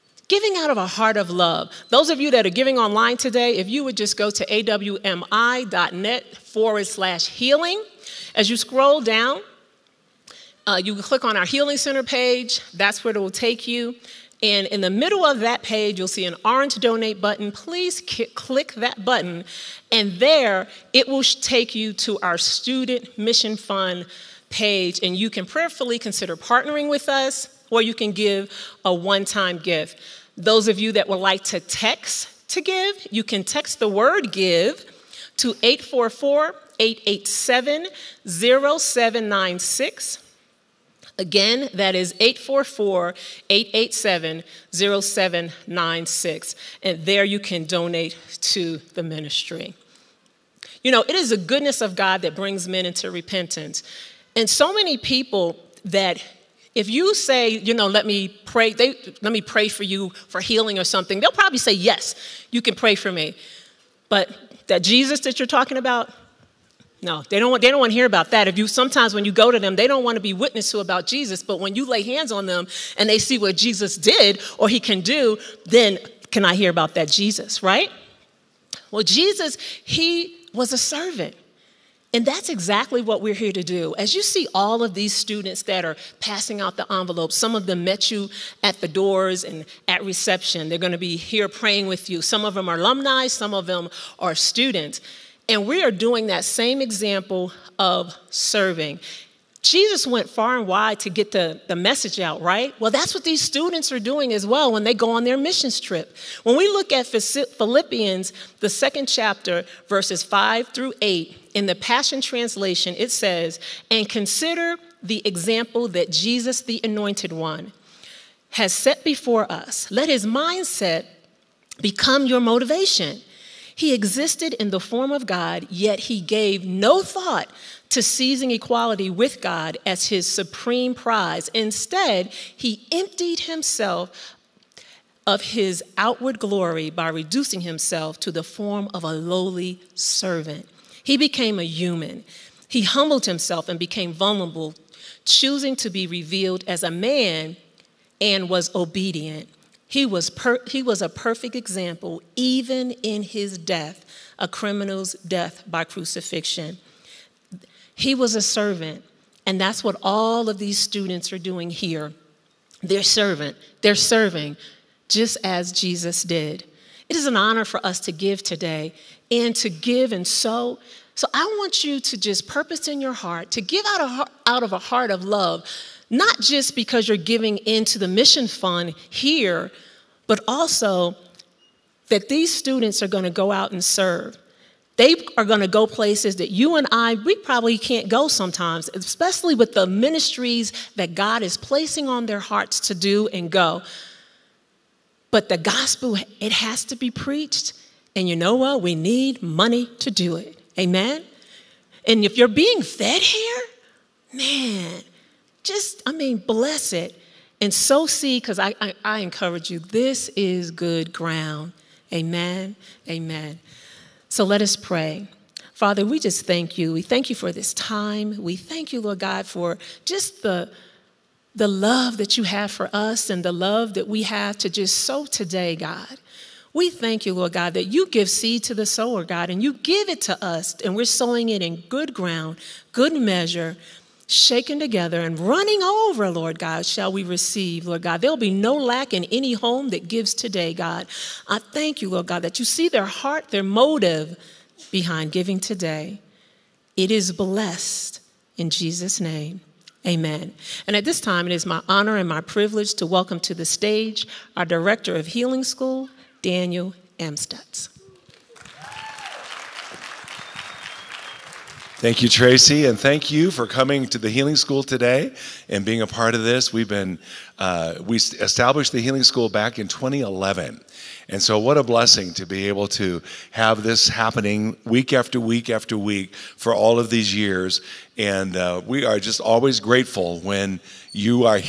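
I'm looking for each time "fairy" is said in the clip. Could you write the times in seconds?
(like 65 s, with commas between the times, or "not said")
not said.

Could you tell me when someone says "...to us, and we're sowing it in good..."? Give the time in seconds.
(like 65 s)
230 s.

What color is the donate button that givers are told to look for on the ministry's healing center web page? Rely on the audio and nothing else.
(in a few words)
Orange.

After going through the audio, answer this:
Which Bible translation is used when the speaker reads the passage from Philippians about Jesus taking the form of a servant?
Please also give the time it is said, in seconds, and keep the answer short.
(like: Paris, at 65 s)
The Passion Translation, at 111 s.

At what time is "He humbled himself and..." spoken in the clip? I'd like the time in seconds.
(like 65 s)
142 s.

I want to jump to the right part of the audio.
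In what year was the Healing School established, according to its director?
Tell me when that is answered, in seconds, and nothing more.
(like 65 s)
269 s.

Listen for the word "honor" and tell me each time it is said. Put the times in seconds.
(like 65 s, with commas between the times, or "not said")
167 s, 251 s.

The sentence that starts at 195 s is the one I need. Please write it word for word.
But the gospel, it has to be preached.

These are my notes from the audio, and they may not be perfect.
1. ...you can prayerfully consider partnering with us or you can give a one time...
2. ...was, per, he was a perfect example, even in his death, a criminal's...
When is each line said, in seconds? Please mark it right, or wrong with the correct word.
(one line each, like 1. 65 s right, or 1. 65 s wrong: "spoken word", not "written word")
1. 25 s right
2. 150 s right.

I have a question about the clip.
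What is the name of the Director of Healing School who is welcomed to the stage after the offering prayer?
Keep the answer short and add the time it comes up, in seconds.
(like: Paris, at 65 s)
Daniel Amstutz, at 256 s.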